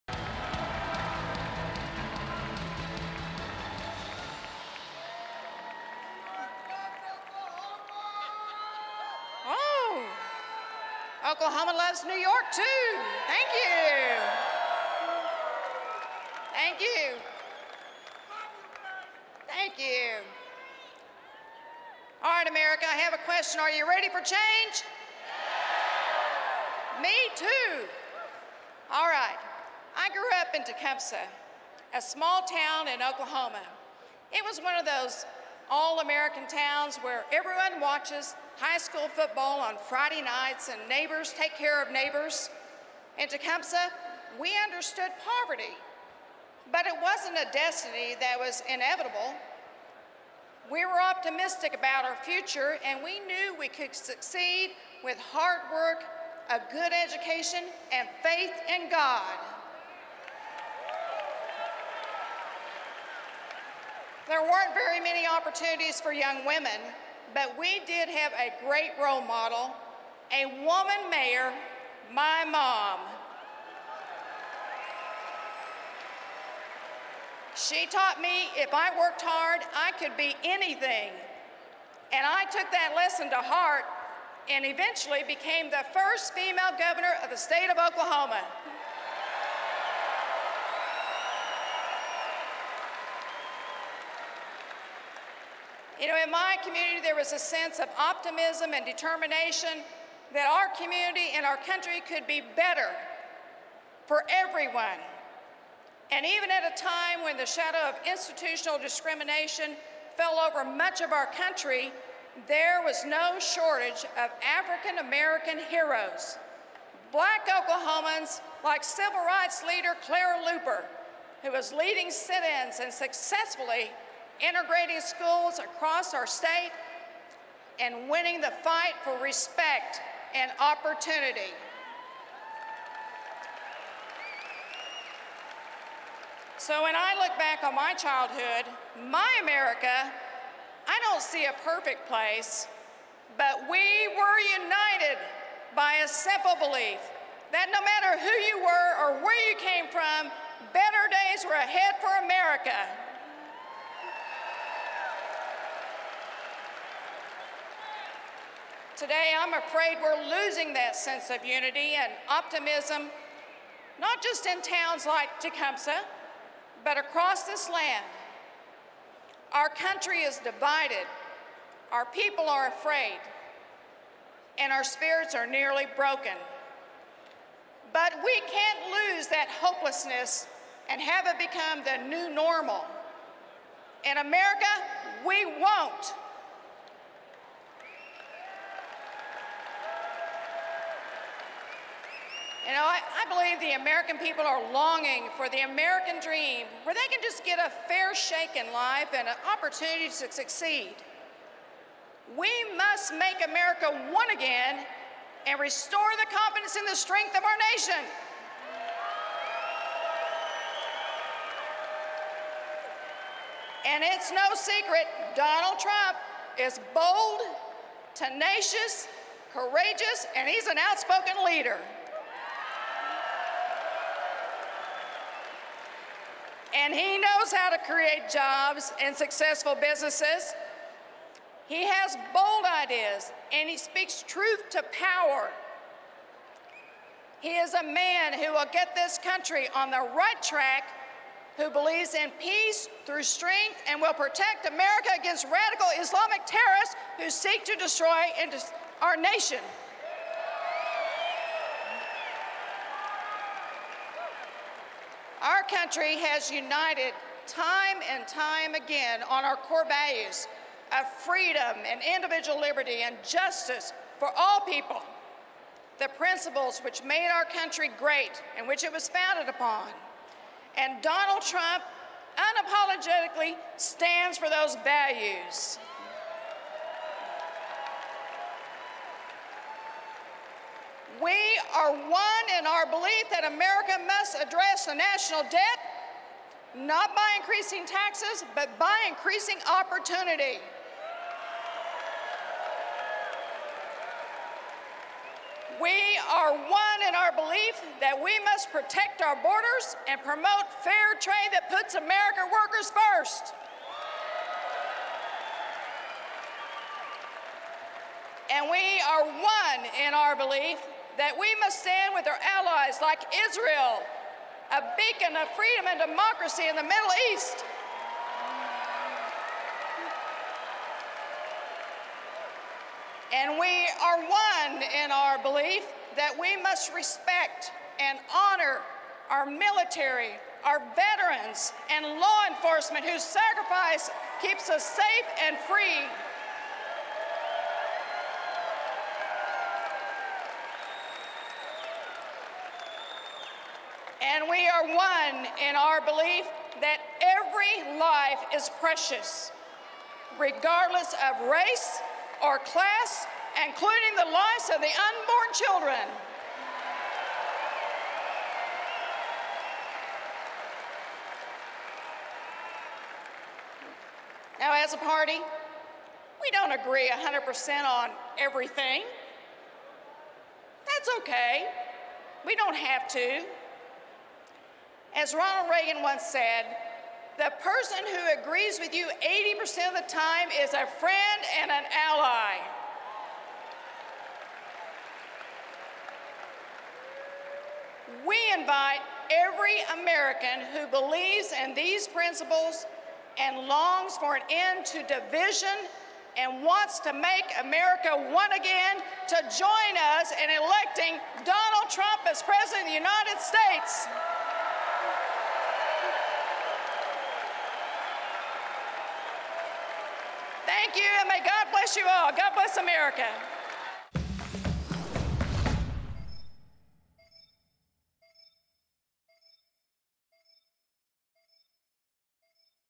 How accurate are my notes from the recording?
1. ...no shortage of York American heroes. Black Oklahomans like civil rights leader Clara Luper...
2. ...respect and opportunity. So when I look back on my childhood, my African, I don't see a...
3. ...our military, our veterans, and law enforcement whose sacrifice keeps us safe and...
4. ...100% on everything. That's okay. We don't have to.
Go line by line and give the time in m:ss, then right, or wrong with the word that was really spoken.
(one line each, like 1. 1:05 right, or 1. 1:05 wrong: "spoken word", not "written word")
1. 1:53 wrong: "African", not "York"
2. 2:09 wrong: "America", not "African"
3. 5:29 right
4. 6:07 right.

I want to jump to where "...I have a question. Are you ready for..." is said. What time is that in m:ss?
0:22.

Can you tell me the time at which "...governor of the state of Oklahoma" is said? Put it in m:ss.
1:26.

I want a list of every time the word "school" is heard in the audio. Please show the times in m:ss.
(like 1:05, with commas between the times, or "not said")
0:38, 2:05.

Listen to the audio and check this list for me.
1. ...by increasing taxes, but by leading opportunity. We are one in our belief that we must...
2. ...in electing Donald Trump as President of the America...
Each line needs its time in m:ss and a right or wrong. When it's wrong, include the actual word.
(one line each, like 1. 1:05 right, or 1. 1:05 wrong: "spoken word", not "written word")
1. 4:47 wrong: "increasing", not "leading"
2. 6:40 wrong: "United", not "America".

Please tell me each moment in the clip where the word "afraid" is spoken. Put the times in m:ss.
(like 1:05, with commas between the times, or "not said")
2:39, 2:52.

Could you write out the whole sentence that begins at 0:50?
We were optimistic about our future, and we knew we could succeed with hard work, a good education, and faith in God.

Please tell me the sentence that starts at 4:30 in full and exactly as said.
And Donald Trump unapologetically stands for those values.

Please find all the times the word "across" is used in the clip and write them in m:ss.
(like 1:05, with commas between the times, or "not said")
2:05, 2:46.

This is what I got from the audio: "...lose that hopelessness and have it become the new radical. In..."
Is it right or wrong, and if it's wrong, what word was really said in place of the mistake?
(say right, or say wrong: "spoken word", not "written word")
wrong: "normal", not "radical".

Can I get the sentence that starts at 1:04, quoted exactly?
There weren't very many opportunities for young women, but we did have a great role model, a woman mayor, my mom.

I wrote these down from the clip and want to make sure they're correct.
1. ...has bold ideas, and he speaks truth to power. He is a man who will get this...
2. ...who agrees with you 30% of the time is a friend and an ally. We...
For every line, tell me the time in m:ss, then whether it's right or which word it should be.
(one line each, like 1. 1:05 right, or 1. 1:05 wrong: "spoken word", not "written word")
1. 3:51 right
2. 6:18 wrong: "80", not "30".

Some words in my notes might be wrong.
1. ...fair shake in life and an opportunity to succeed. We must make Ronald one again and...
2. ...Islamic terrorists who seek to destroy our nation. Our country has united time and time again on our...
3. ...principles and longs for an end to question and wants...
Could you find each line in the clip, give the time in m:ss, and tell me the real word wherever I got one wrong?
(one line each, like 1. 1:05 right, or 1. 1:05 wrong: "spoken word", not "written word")
1. 3:17 wrong: "America", not "Ronald"
2. 4:05 right
3. 6:32 wrong: "division", not "question".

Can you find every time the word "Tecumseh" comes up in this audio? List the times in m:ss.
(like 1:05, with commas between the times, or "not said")
0:30, 0:43, 2:45.